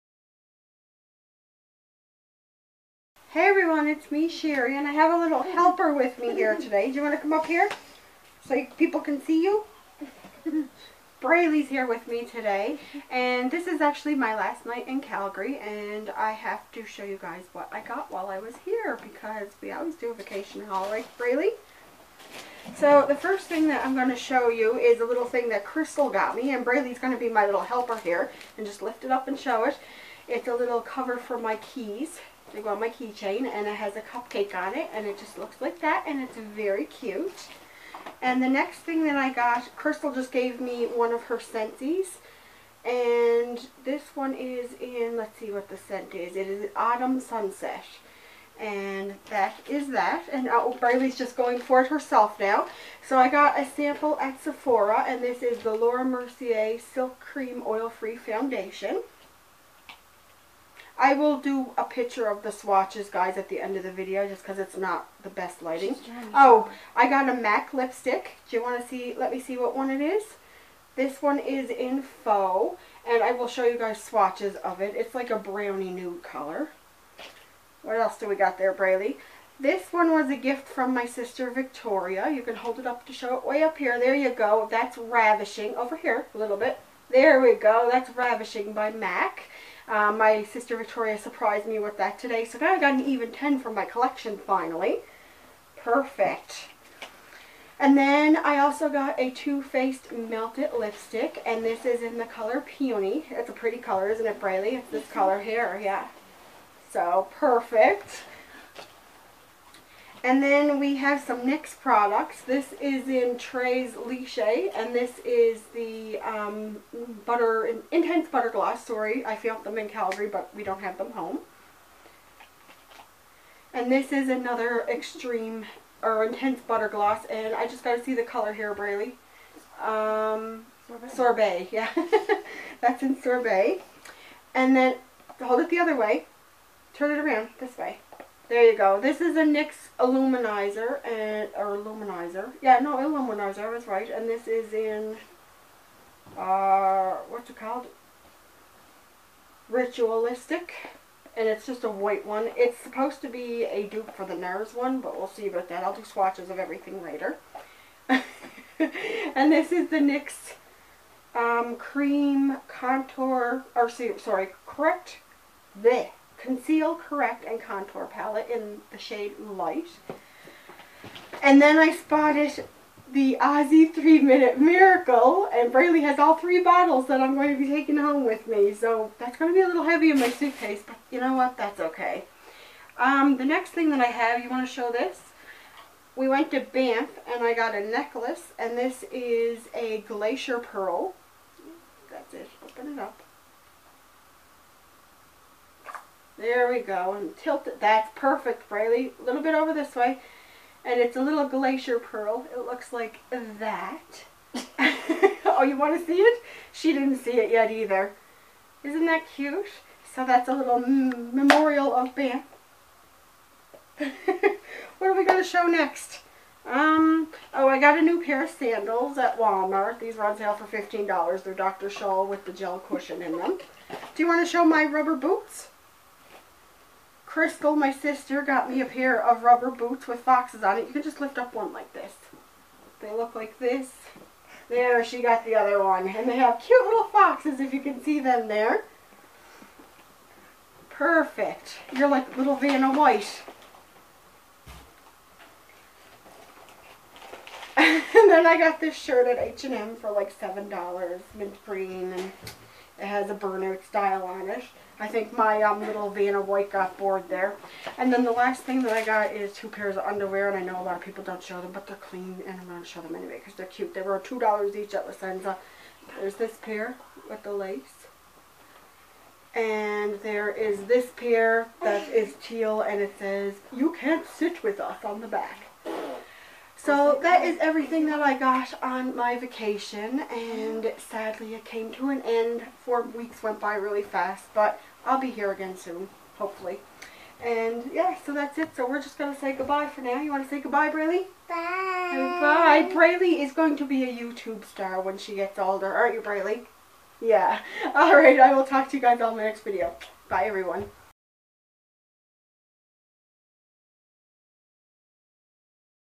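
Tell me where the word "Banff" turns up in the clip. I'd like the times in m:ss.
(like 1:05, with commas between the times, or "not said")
3:06, 3:32.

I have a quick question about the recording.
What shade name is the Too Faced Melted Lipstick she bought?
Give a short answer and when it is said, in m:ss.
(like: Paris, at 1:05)
Peony, at 1:42.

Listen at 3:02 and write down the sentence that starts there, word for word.
Um, the next thing that I have, you want to show this?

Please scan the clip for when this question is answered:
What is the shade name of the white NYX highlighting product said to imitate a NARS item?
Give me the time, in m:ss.
2:29.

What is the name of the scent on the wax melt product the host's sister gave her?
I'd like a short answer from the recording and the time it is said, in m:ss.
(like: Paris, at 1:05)
Autumn Sunset, at 0:46.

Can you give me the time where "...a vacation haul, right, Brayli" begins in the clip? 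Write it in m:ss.
0:20.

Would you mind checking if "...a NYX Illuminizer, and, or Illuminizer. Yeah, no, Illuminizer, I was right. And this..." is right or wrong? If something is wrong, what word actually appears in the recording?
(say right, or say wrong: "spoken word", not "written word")
right.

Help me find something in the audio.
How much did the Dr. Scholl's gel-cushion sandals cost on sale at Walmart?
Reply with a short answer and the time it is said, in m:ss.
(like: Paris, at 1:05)
$15, at 3:40.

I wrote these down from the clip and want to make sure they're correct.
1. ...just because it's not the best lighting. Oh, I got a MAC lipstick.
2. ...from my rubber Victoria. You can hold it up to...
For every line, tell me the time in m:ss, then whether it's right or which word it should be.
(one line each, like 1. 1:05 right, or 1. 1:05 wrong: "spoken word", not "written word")
1. 1:04 right
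2. 1:20 wrong: "sister", not "rubber".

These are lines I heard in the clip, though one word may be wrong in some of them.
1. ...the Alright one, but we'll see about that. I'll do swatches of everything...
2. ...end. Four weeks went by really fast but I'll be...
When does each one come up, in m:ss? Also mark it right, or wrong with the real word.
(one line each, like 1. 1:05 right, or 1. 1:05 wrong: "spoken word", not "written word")
1. 2:34 wrong: "NARS", not "Alright"
2. 4:42 right.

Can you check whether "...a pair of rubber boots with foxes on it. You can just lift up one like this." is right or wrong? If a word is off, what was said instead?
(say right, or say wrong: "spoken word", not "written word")
right.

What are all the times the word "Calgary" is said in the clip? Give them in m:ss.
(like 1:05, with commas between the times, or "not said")
0:14, 1:59.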